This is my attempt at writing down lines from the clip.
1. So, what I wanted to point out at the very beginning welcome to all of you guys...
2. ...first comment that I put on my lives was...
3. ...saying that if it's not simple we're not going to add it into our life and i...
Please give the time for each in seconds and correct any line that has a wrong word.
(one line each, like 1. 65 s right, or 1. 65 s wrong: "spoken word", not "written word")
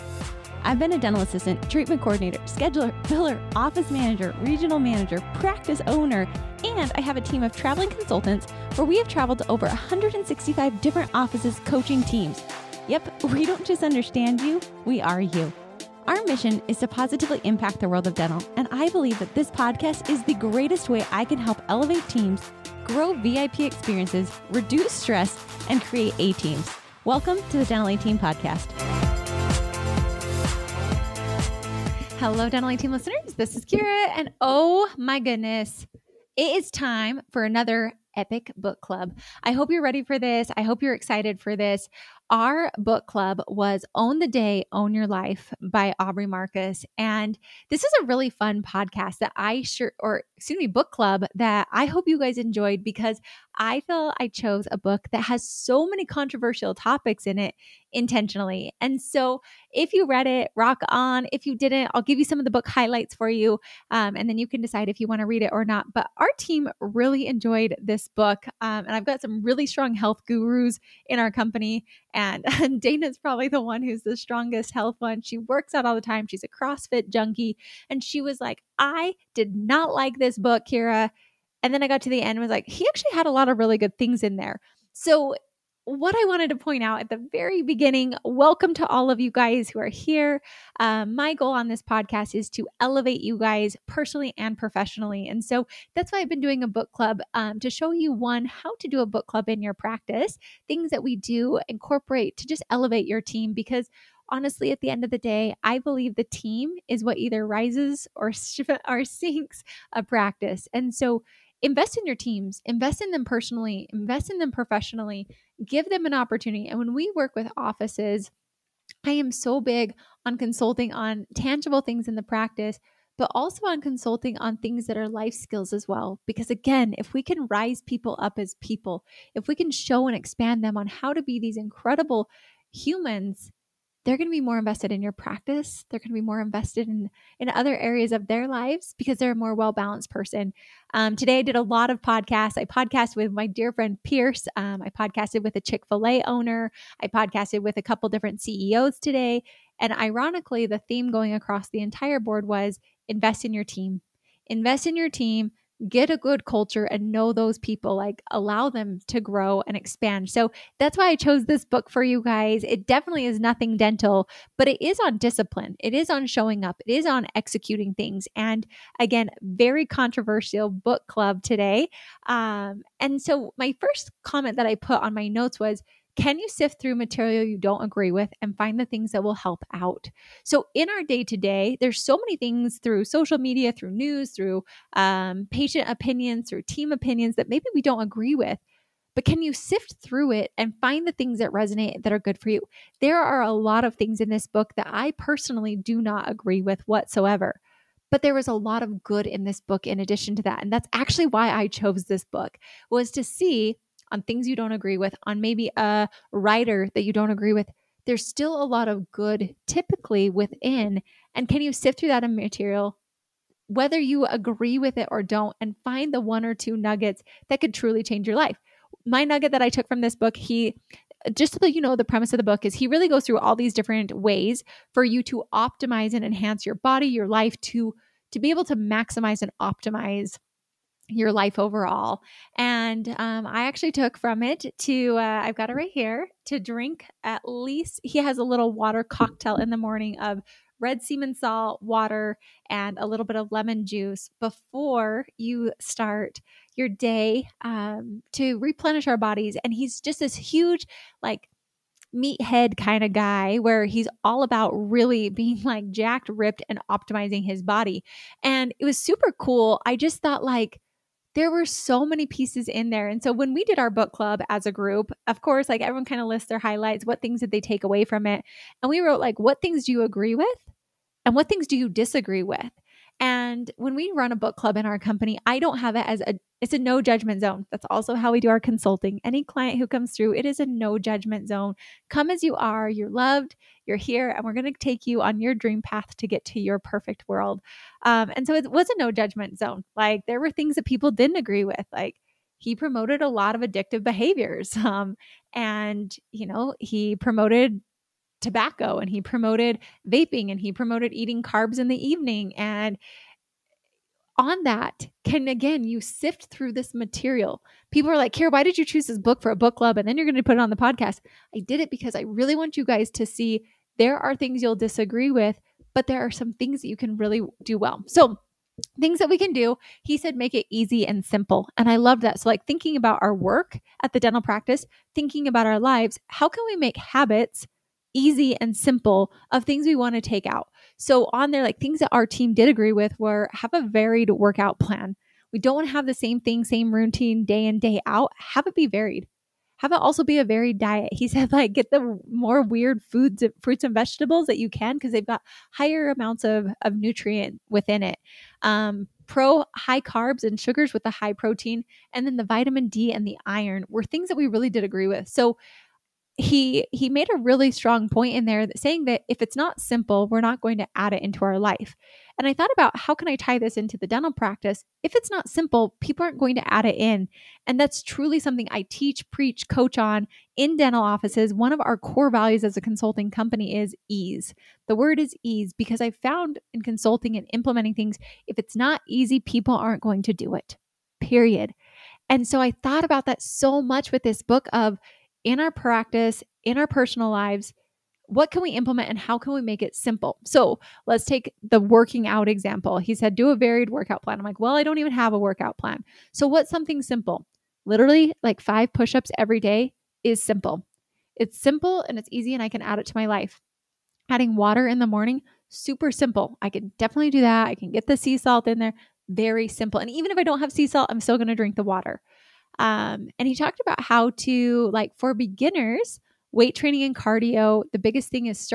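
1. 84 s right
2. 173 s wrong: "notes", not "lives"
3. 358 s right.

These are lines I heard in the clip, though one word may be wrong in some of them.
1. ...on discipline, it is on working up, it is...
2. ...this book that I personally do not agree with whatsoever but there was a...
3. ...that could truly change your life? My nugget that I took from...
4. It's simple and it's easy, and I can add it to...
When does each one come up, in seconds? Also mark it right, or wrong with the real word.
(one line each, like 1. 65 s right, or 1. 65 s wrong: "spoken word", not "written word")
1. 165 s wrong: "showing", not "working"
2. 194 s right
3. 217 s right
4. 401 s right.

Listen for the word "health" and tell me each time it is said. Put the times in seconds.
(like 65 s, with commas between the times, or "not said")
69 s, 74 s.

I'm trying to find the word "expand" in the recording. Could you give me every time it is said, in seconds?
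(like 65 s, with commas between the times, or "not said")
130 s, 159 s.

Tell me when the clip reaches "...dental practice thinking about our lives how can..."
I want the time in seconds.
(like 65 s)
324 s.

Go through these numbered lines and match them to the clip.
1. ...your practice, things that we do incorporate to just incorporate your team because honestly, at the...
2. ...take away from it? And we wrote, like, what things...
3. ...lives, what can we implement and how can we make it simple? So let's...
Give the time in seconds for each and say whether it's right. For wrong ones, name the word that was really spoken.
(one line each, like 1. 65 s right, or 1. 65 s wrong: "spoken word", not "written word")
1. 99 s wrong: "elevate", not "incorporate"
2. 267 s right
3. 387 s right.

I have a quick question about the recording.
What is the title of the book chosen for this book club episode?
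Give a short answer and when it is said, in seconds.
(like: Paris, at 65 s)
Own the Day, Own Your Life, at 43 s.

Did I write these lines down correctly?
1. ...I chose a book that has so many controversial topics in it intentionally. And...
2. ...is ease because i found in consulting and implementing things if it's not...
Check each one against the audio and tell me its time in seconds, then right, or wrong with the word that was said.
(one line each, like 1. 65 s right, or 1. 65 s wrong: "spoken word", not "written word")
1. 54 s right
2. 375 s right.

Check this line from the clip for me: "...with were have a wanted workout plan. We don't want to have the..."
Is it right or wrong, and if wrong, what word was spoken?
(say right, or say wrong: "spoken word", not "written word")
wrong: "varied", not "wanted".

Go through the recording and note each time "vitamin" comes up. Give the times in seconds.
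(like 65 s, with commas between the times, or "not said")
352 s.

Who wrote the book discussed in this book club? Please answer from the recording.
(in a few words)
Aubrey Marcus.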